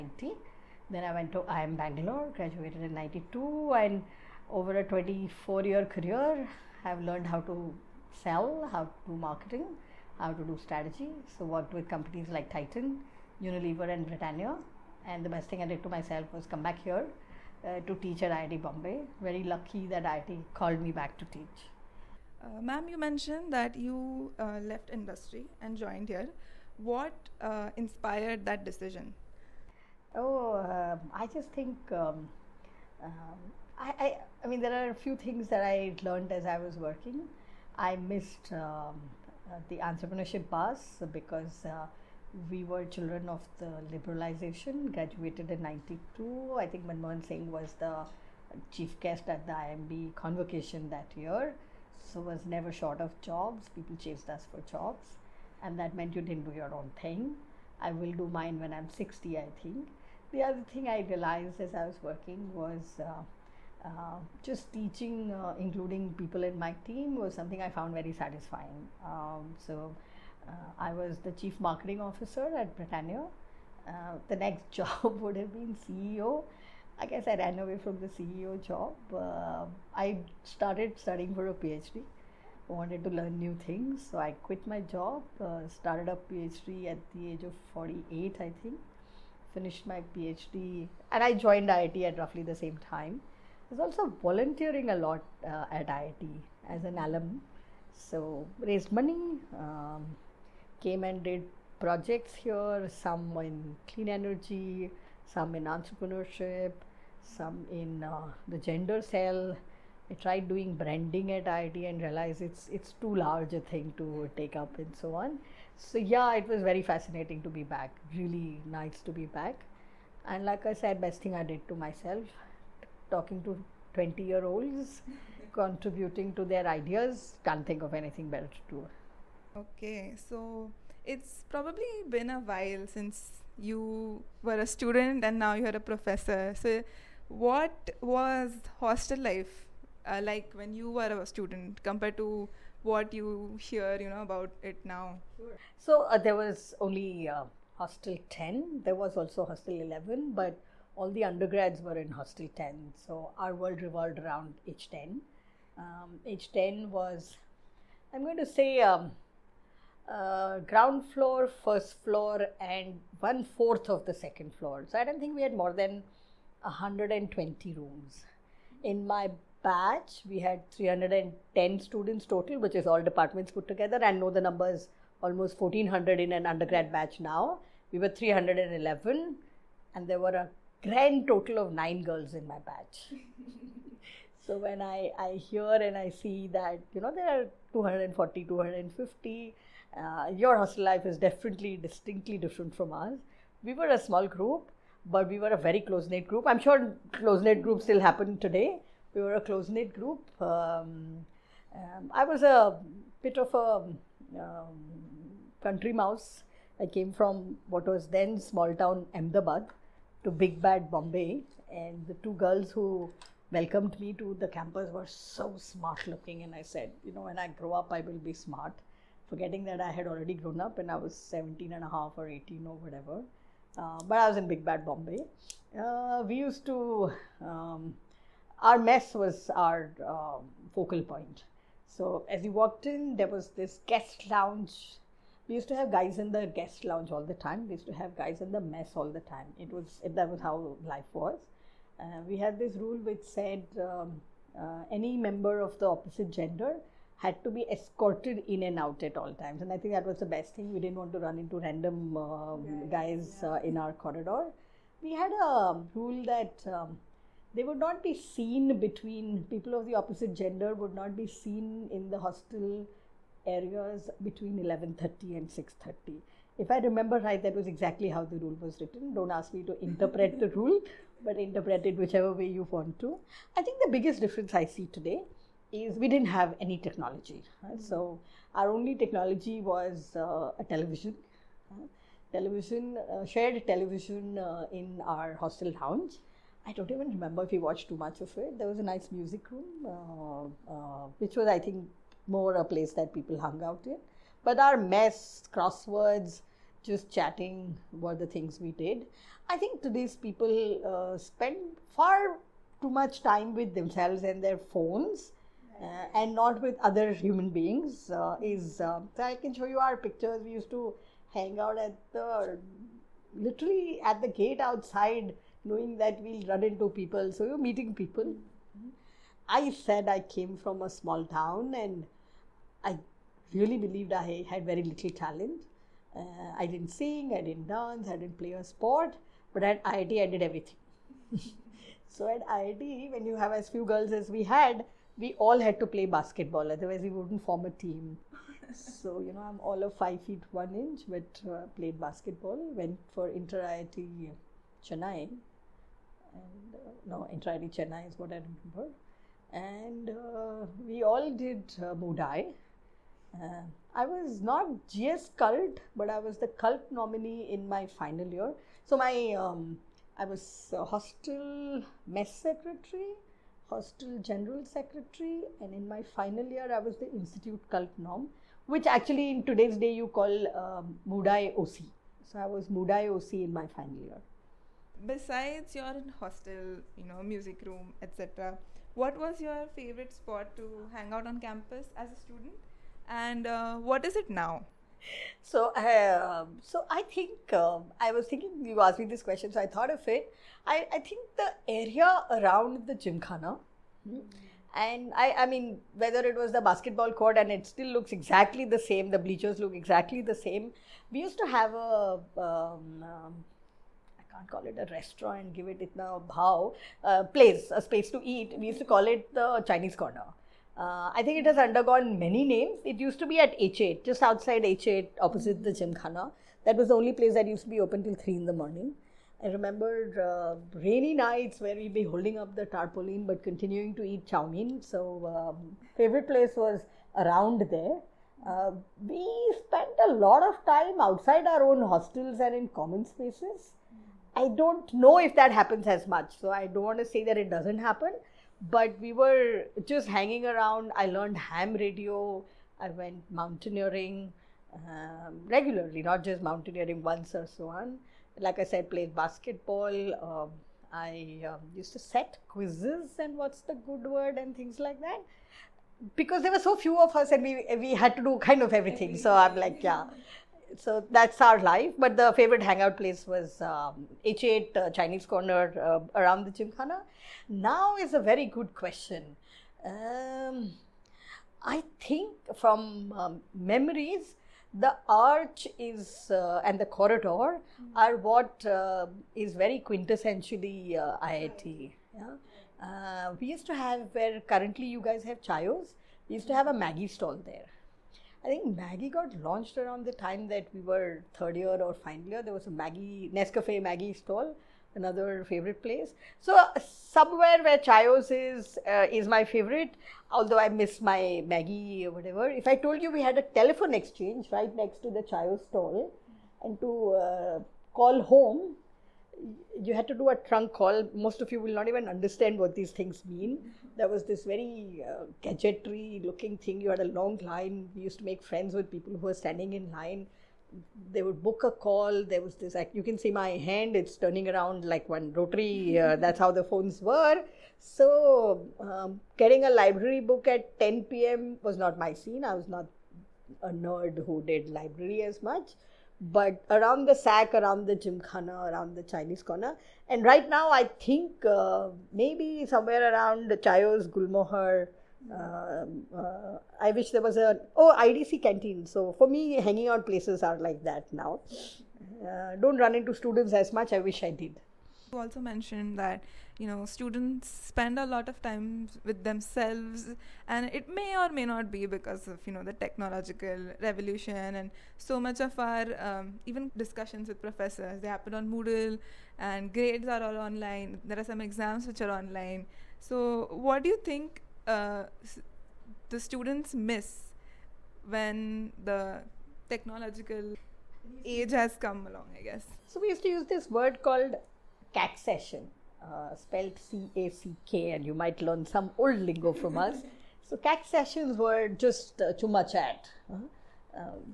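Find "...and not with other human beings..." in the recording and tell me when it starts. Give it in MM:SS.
05:06.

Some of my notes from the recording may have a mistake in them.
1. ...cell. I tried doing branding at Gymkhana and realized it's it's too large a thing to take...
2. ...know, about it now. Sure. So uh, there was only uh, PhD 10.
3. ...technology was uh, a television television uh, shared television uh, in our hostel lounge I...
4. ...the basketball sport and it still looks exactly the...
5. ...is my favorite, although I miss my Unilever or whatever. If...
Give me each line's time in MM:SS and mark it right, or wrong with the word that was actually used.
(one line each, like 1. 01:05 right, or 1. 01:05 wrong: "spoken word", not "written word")
1. 01:49 wrong: "IIT", not "Gymkhana"
2. 02:24 wrong: "Hostel", not "PhD"
3. 04:39 right
4. 06:36 wrong: "court", not "sport"
5. 08:19 wrong: "Maggi", not "Unilever".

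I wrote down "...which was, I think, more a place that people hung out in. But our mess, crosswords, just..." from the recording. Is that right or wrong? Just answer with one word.
right.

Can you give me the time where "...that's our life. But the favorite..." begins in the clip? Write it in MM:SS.
07:41.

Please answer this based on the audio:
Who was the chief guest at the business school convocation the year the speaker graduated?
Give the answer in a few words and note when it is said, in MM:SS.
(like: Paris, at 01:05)
Manmohan Singh, at 00:46.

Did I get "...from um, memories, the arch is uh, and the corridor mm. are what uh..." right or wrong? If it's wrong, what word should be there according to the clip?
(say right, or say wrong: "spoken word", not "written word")
right.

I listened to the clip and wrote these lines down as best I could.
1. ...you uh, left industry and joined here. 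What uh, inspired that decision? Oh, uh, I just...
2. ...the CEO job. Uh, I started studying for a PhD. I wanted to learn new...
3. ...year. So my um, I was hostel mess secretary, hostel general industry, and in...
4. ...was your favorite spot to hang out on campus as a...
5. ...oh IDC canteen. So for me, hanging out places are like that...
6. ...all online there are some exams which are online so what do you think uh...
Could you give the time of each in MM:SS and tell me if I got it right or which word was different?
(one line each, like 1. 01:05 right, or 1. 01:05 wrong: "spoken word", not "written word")
1. 00:23 right
2. 01:18 right
3. 05:58 wrong: "secretary", not "industry"
4. 06:19 right
5. 09:07 right
6. 09:30 right.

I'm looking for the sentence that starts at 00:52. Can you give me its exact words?
So was never short of jobs.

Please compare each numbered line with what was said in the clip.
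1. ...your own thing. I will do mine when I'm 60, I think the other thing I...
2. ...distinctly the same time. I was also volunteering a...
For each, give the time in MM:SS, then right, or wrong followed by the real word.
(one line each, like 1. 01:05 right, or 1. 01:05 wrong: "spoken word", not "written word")
1. 00:56 right
2. 01:32 wrong: "roughly", not "distinctly".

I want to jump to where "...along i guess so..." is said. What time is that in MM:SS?
09:42.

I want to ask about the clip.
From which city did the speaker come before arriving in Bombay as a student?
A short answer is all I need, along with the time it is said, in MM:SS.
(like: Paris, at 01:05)
Ahmedabad, at 03:28.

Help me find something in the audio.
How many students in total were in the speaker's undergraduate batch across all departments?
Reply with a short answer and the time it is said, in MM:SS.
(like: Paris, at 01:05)
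310, at 02:50.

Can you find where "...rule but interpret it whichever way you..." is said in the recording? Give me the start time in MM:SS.
04:30.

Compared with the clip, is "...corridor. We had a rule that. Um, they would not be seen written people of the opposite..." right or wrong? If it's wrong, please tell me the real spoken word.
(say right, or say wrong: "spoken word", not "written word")
wrong: "between", not "written".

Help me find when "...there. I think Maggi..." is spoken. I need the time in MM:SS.
08:07.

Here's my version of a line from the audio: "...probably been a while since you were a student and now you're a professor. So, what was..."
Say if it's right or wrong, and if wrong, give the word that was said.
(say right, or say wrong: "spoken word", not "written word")
right.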